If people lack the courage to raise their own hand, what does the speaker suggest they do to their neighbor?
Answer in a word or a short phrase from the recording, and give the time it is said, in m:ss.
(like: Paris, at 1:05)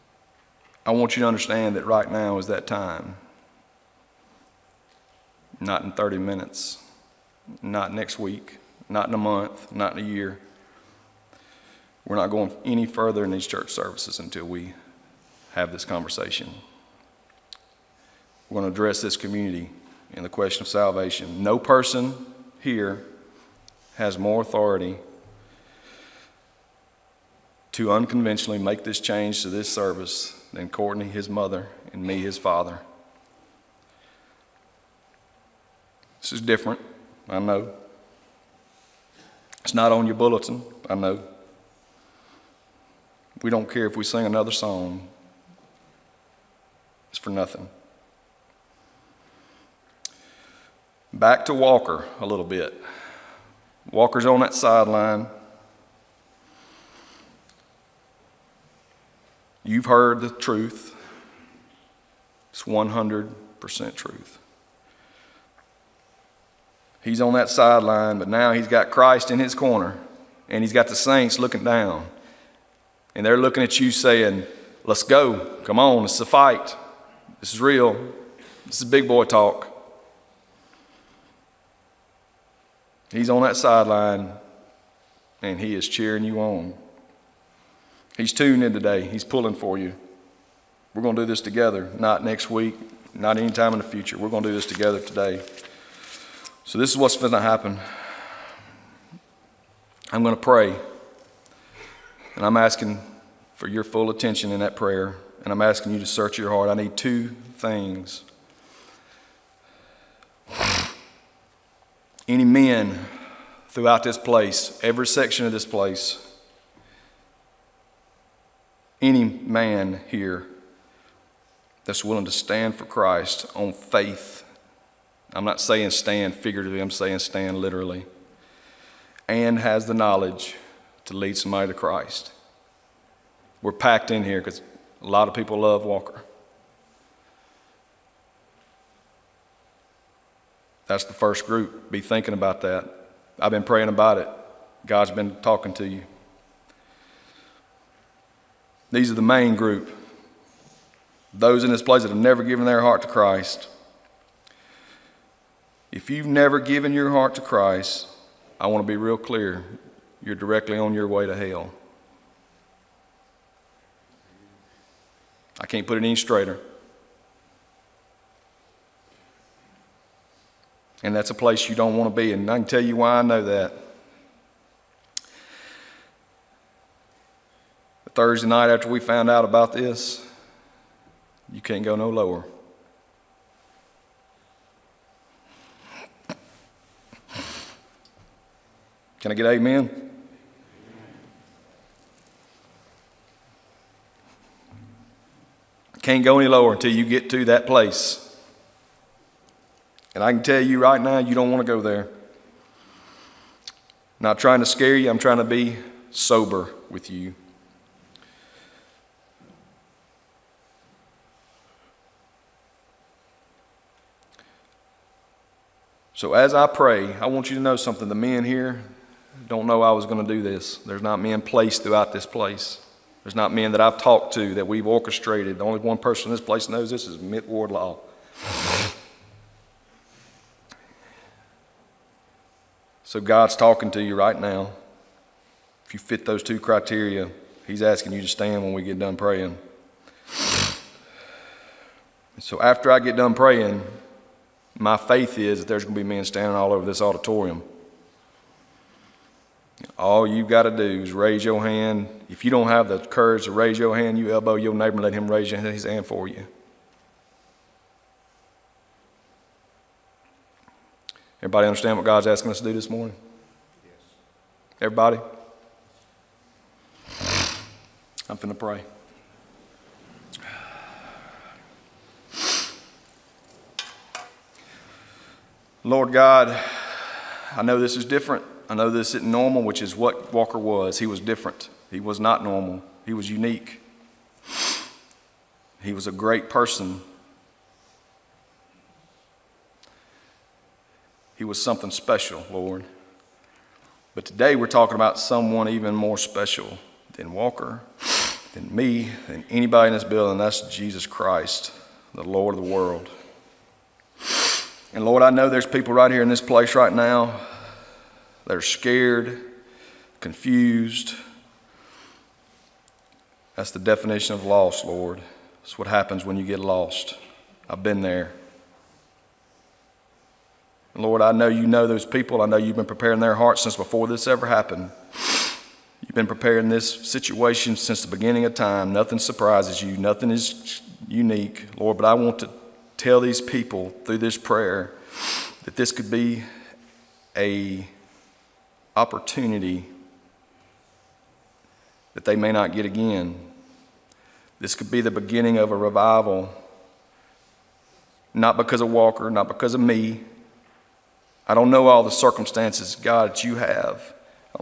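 elbow, at 4:14.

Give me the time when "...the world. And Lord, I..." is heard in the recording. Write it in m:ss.
5:02.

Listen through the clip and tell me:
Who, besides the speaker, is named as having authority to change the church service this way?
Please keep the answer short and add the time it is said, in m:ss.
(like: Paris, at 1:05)
Courtney, at 0:30.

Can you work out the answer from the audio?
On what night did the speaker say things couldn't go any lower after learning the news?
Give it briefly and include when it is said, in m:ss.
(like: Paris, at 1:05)
Thursday, at 2:58.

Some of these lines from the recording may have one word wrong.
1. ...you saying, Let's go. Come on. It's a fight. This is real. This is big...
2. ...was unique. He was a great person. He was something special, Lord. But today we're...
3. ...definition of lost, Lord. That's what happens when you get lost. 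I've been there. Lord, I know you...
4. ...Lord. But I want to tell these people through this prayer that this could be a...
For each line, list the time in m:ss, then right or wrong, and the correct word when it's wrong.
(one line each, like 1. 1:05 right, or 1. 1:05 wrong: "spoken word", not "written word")
1. 1:13 right
2. 4:43 right
3. 5:13 right
4. 5:31 right.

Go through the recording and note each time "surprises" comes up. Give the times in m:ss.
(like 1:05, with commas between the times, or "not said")
5:29.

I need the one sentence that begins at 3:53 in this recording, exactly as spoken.
so God's talking to you right now.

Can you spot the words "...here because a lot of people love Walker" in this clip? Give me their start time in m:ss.
2:14.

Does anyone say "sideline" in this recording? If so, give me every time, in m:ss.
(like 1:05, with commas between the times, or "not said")
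0:54, 1:07, 1:23.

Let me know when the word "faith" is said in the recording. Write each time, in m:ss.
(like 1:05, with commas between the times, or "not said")
2:03, 4:04.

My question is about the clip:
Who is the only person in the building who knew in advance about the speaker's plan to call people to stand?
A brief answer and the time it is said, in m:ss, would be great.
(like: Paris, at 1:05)
Mitt Wardlaw, at 3:47.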